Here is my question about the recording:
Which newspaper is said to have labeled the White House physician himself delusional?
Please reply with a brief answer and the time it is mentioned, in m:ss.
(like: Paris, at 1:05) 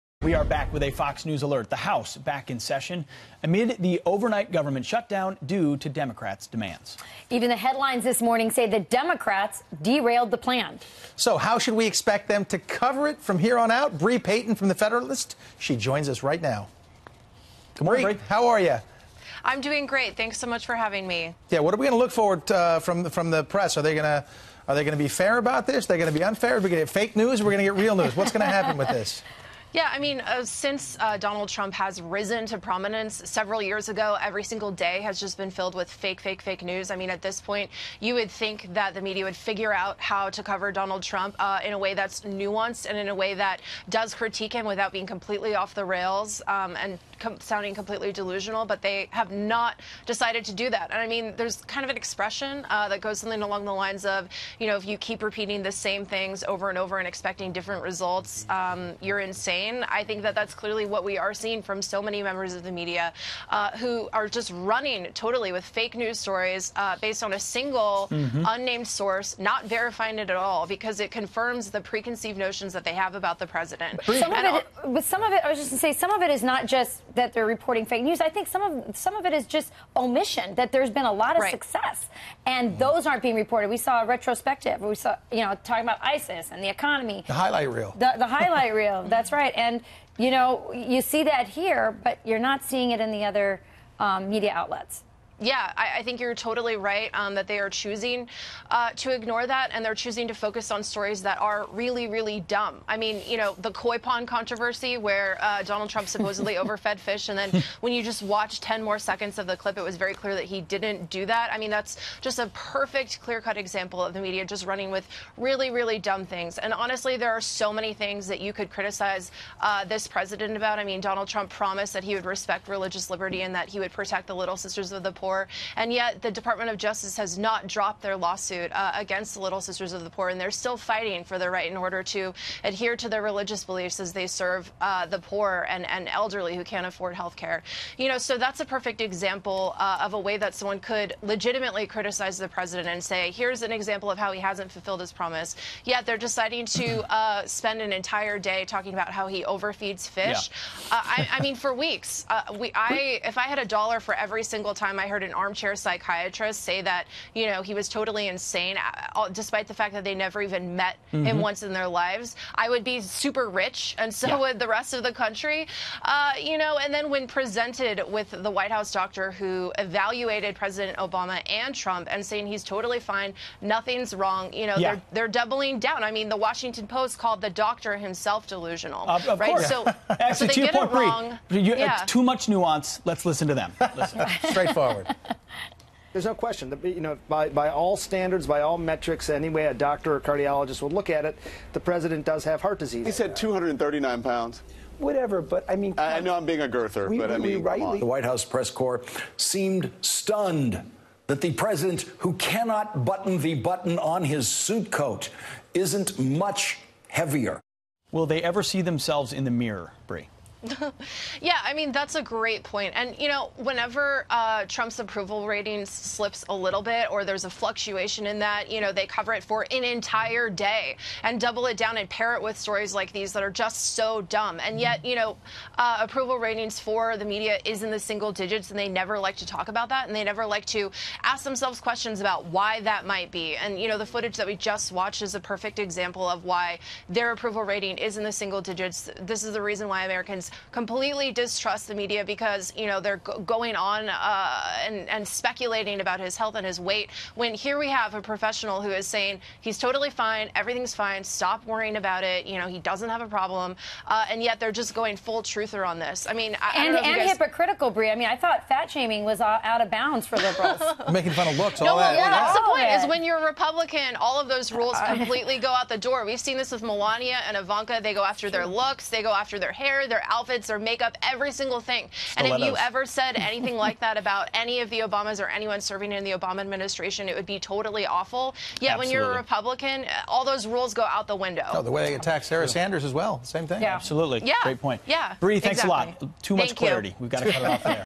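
The Washington Post, at 2:56.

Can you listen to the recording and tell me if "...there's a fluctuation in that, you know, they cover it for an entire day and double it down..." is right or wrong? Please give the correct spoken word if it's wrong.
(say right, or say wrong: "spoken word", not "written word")
right.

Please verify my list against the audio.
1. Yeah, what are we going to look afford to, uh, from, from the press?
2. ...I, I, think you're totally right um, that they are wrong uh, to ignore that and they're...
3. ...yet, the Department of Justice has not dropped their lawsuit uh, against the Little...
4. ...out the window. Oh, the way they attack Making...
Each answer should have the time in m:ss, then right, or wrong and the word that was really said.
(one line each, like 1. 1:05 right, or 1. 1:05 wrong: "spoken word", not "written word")
1. 0:21 wrong: "forward", not "afford"
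2. 1:35 wrong: "choosing", not "wrong"
3. 2:05 right
4. 4:41 wrong: "Sarah", not "Making".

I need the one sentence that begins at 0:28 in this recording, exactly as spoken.
What's going to happen with this?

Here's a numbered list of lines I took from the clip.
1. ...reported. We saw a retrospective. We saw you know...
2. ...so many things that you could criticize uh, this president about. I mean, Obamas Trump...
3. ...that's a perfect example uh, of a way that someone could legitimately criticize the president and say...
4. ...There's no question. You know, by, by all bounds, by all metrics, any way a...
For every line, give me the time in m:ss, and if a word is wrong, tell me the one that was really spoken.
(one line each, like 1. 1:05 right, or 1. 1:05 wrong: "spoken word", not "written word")
1. 1:23 right
2. 1:57 wrong: "Donald", not "Obamas"
3. 2:18 right
4. 3:06 wrong: "standards", not "bounds".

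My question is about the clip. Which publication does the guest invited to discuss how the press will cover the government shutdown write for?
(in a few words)
The Federalist.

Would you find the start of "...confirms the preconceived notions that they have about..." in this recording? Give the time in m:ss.
1:11.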